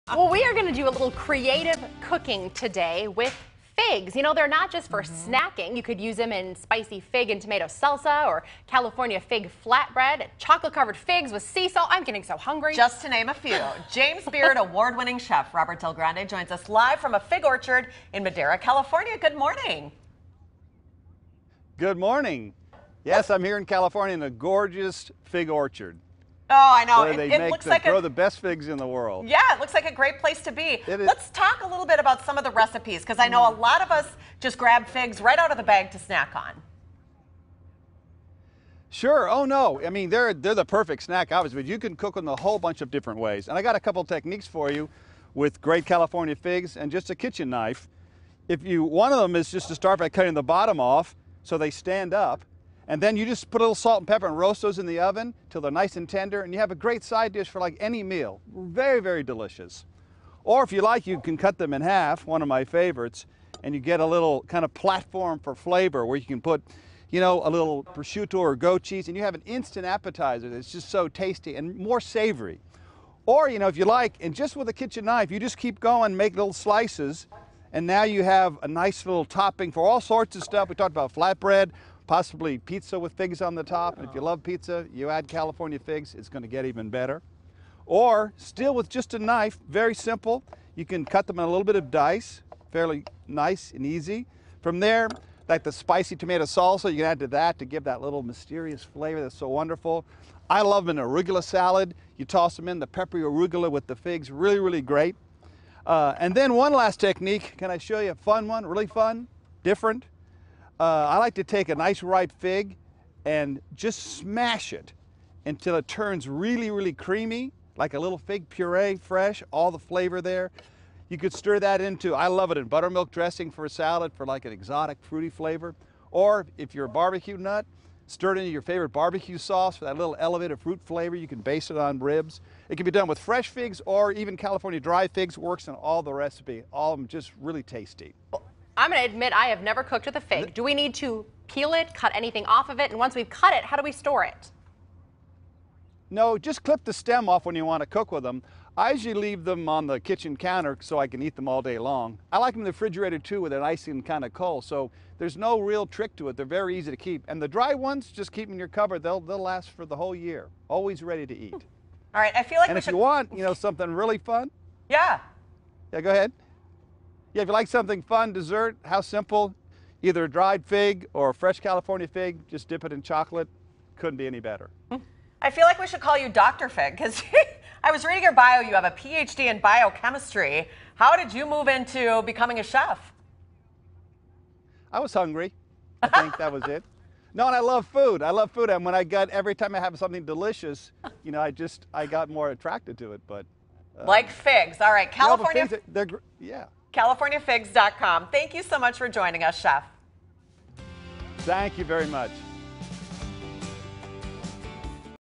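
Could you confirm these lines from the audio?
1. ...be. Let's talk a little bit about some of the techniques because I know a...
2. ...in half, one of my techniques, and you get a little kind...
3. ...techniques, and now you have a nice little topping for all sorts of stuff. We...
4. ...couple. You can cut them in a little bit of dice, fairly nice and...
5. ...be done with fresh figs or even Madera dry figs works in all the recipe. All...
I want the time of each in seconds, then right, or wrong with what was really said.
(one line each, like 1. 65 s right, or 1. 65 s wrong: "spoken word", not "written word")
1. 30 s wrong: "recipes", not "techniques"
2. 61 s wrong: "favorites", not "techniques"
3. 76 s wrong: "slices", not "techniques"
4. 89 s wrong: "simple", not "couple"
5. 132 s wrong: "California", not "Madera".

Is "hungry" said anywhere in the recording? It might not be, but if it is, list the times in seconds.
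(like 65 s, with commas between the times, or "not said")
12 s, 185 s.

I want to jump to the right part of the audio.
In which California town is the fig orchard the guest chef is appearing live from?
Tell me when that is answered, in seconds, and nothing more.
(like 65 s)
18 s.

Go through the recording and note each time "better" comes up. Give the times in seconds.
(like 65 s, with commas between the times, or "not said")
86 s, 174 s.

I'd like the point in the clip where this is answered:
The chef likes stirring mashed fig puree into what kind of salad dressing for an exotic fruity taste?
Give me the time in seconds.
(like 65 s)
122 s.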